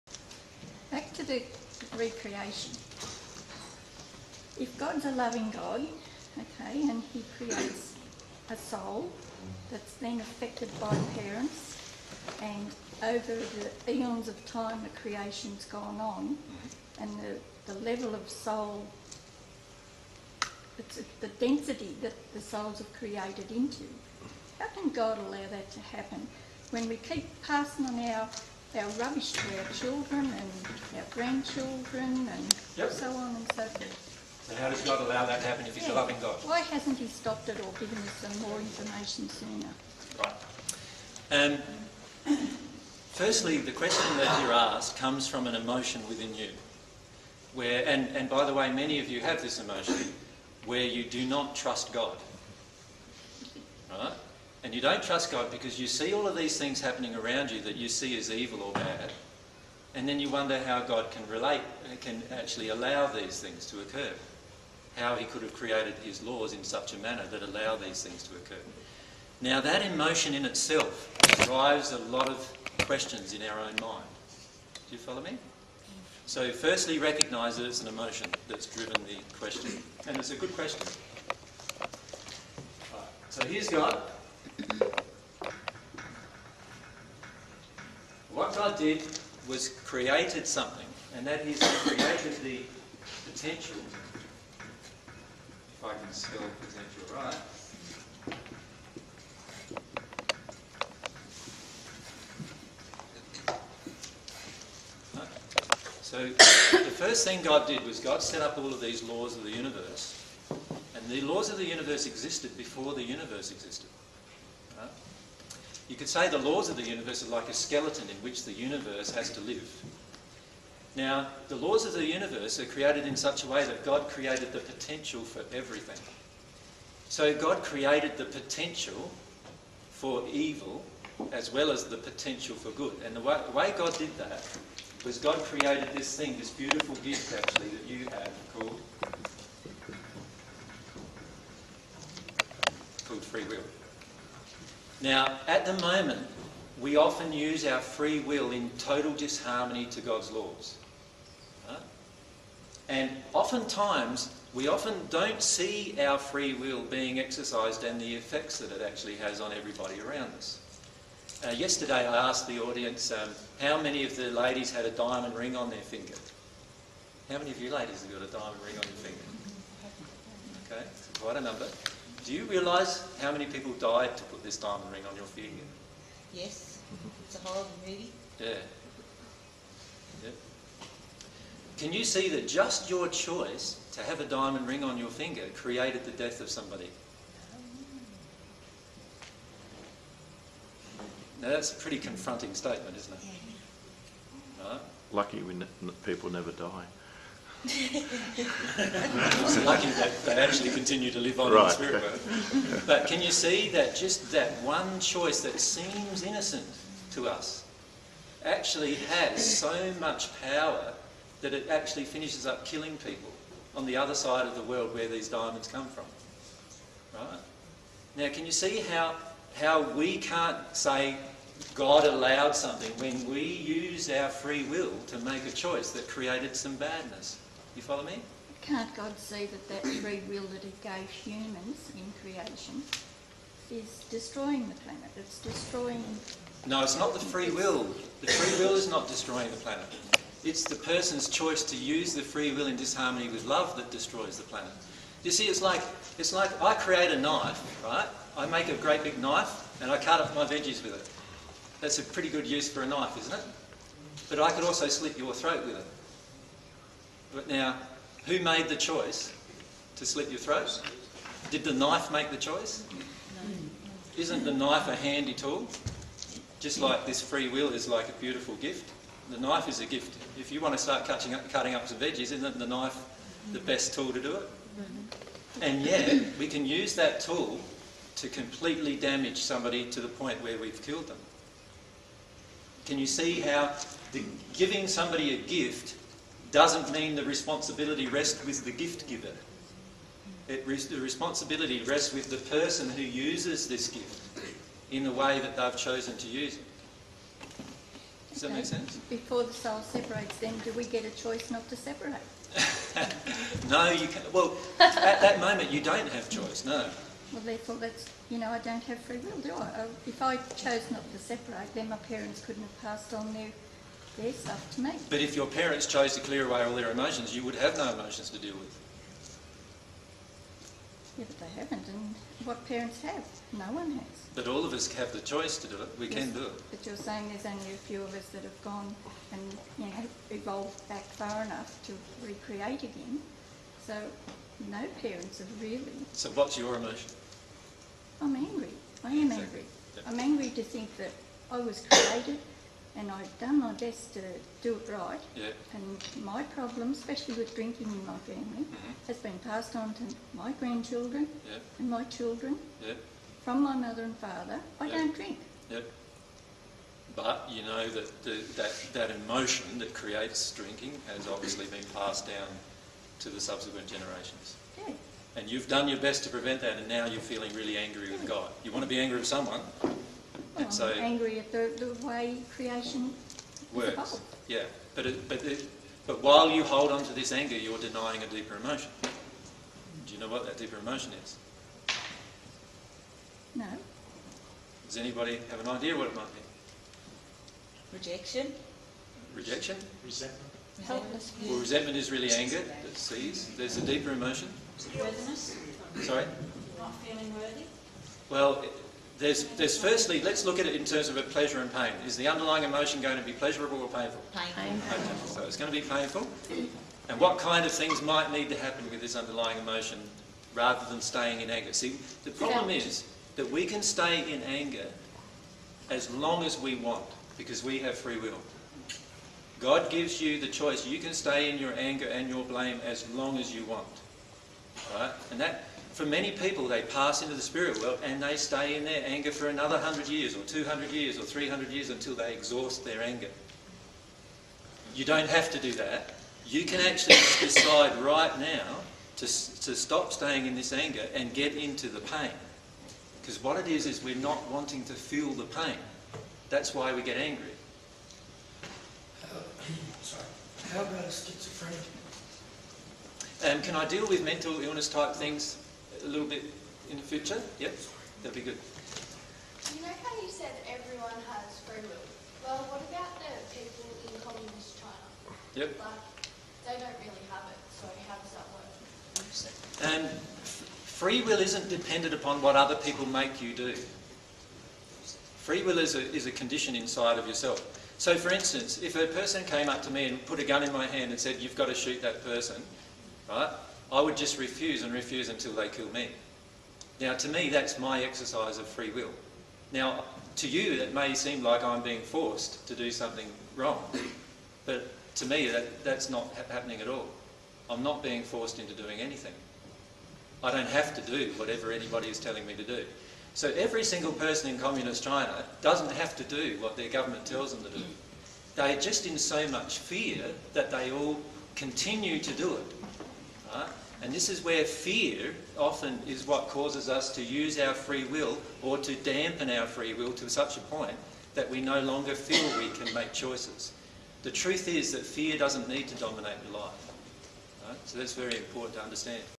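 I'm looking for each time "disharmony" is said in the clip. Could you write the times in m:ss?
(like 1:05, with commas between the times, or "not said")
2:29, 4:02.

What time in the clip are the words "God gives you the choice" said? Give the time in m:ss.
6:59.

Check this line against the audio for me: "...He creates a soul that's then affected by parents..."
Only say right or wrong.
right.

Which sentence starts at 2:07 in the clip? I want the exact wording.
So God created the potential for evil as well as the potential for good.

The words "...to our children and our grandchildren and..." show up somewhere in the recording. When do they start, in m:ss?
0:29.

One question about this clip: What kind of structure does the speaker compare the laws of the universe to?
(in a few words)
A skeleton.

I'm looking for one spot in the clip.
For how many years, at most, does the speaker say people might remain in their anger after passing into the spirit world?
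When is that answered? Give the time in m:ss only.
7:11.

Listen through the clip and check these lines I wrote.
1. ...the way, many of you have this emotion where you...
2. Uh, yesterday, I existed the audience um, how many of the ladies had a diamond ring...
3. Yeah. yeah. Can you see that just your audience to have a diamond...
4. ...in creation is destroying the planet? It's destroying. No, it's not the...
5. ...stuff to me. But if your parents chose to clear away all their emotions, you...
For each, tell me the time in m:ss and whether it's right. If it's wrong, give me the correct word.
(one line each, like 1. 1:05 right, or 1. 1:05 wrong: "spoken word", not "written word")
1. 0:48 right
2. 2:41 wrong: "asked", not "existed"
3. 2:58 wrong: "choice", not "audience"
4. 3:51 right
5. 5:14 right.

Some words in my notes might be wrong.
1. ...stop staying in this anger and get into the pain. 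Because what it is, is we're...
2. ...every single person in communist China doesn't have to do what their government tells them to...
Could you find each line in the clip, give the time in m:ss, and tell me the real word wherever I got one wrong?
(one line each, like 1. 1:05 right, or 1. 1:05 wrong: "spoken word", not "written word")
1. 7:19 right
2. 8:23 right.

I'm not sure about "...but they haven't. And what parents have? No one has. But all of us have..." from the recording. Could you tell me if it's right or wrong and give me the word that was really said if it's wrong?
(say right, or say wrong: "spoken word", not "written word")
right.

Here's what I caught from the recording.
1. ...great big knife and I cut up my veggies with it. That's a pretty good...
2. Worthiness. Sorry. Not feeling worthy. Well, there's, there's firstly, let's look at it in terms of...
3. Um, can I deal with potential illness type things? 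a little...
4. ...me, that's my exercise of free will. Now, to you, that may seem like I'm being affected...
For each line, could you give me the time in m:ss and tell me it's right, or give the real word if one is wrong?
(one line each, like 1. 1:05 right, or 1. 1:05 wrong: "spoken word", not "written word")
1. 4:08 right
2. 6:34 right
3. 7:33 wrong: "mental", not "potential"
4. 8:07 wrong: "forced", not "affected".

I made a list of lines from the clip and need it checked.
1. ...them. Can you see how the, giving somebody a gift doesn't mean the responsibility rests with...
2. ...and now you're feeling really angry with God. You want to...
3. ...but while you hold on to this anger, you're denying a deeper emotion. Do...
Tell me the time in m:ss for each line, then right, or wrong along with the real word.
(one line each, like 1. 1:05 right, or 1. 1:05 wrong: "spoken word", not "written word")
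1. 4:41 right
2. 6:06 right
3. 6:16 right.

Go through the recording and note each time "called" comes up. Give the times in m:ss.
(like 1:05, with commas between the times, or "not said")
2:18, 2:23.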